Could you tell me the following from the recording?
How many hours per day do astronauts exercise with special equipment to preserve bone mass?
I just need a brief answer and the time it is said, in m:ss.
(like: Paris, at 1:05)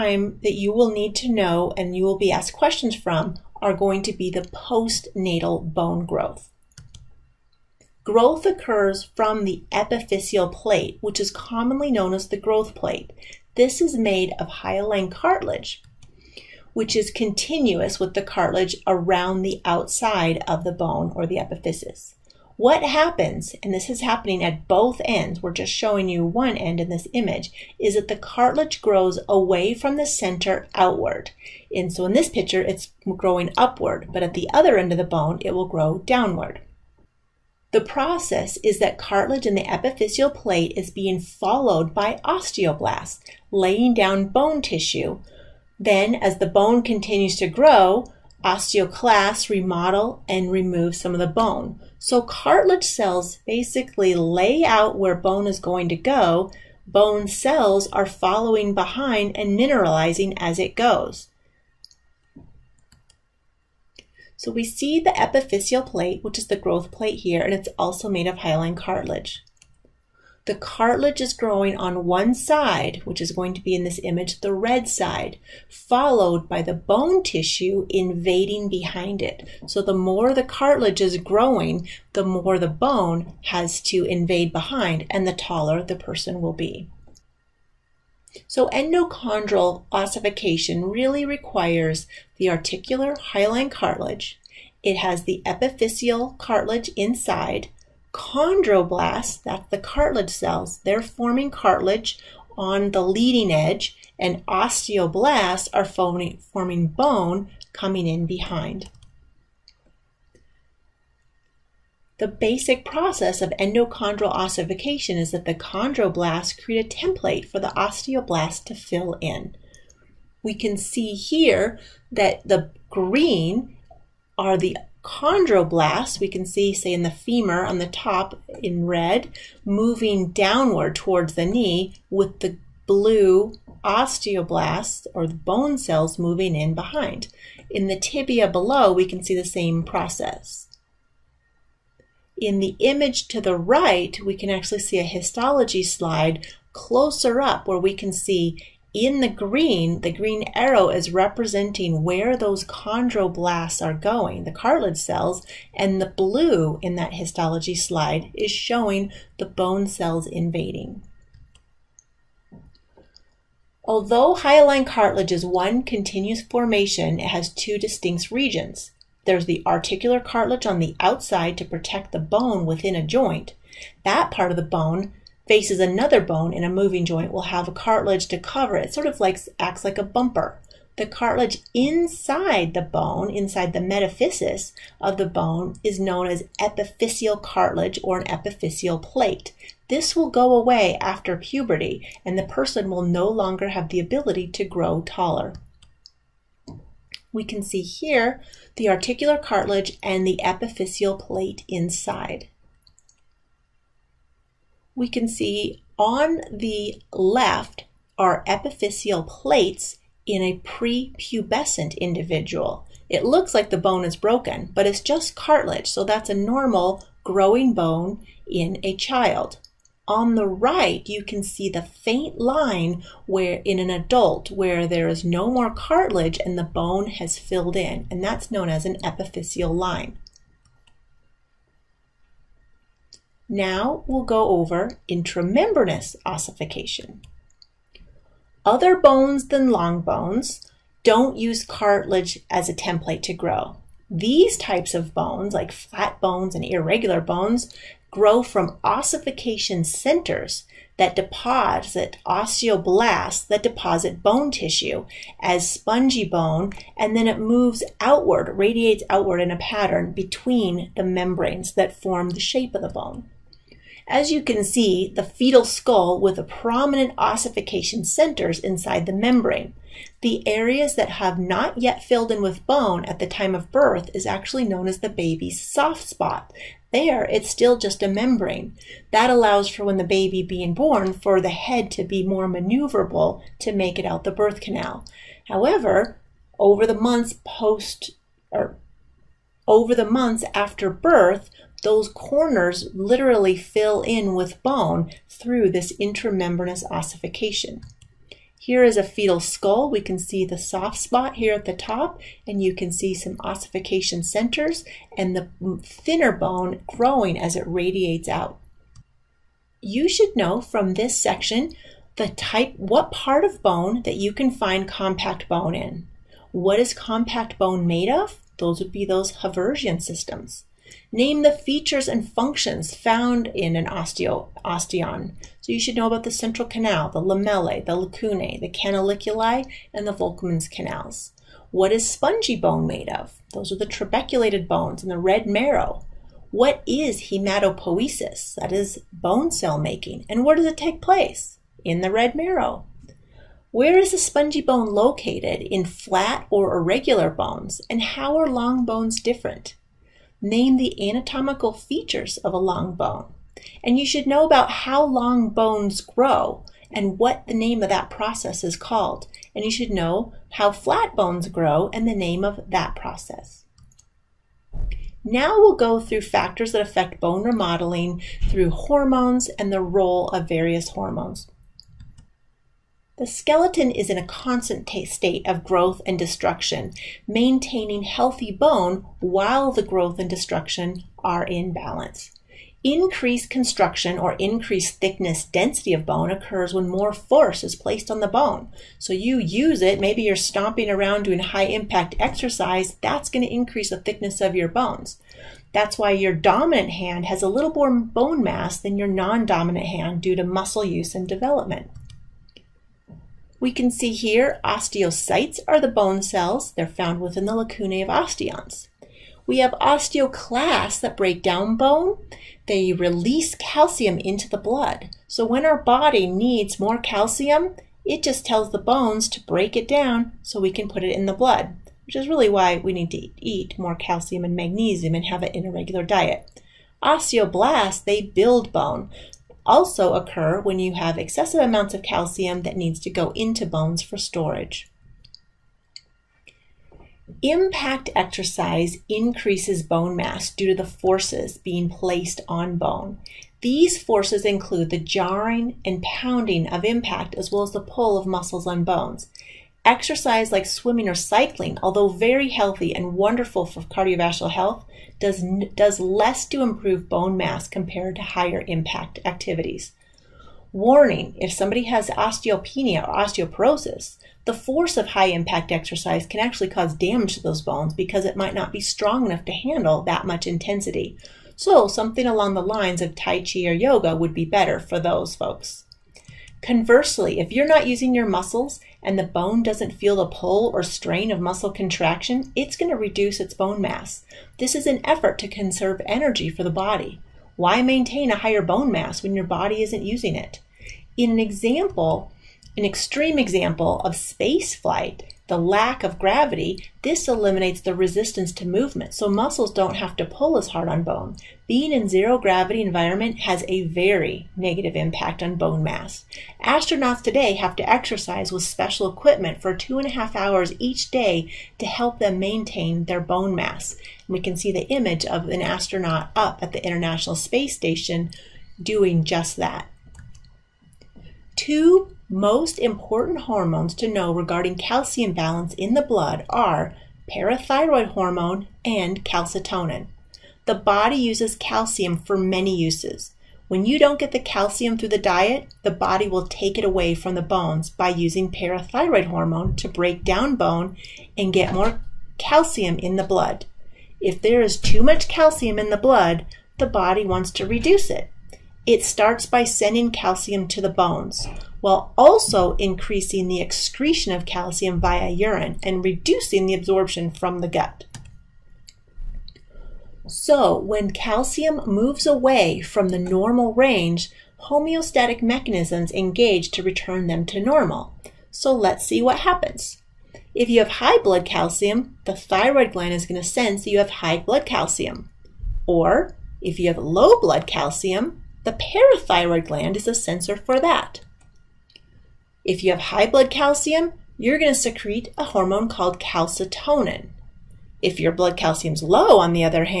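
2.5 hours, at 8:29.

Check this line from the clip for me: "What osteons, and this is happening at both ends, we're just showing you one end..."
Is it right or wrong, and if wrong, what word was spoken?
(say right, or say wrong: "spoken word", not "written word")
wrong: "happens", not "osteons".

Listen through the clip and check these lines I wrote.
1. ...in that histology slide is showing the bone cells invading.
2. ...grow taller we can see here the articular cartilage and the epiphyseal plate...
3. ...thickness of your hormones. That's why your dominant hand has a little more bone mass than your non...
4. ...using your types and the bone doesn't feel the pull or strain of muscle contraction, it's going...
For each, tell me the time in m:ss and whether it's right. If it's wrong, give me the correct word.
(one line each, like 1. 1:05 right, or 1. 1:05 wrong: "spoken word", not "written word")
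1. 2:36 right
2. 3:14 right
3. 6:34 wrong: "bones", not "hormones"
4. 7:57 wrong: "muscles", not "types".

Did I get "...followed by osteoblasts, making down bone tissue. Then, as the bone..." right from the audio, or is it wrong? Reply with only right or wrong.
wrong.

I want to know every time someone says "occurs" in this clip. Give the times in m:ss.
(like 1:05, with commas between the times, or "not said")
0:08, 6:26, 7:10.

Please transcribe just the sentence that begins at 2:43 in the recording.
Although hyaline cartilage is one continuous formation, it has two distinct regions.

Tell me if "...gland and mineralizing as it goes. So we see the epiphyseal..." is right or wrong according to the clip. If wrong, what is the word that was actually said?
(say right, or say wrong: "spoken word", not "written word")
wrong: "behind", not "gland".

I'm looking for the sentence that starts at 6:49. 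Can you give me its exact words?
We have osteoclasts that break down bone they release calcium into the blood.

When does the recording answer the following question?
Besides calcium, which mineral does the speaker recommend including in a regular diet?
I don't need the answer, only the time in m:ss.
7:04.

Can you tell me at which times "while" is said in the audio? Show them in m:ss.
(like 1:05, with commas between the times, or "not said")
6:19, 9:11.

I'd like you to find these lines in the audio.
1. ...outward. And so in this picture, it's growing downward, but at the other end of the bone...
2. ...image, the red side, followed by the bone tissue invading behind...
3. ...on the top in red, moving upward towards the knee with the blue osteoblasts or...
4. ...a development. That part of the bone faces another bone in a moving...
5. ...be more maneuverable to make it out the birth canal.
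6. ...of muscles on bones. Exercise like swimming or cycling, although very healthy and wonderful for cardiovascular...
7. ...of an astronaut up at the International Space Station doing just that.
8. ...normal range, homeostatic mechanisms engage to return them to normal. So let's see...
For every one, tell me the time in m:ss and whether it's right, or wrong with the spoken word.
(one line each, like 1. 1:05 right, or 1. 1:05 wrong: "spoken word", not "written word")
1. 0:30 wrong: "upward", not "downward"
2. 1:14 right
3. 2:07 wrong: "downward", not "upward"
4. 2:52 wrong: "joint", not "development"
5. 4:42 right
6. 7:28 right
7. 8:35 right
8. 9:23 right.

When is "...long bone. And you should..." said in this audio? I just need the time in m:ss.
5:52.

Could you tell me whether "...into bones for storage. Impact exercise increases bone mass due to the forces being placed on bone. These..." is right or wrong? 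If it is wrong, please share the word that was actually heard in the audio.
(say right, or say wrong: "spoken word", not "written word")
right.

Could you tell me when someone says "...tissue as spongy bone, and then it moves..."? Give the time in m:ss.
4:14.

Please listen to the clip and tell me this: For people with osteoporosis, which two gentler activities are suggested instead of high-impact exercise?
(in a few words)
Tai Chi or yoga.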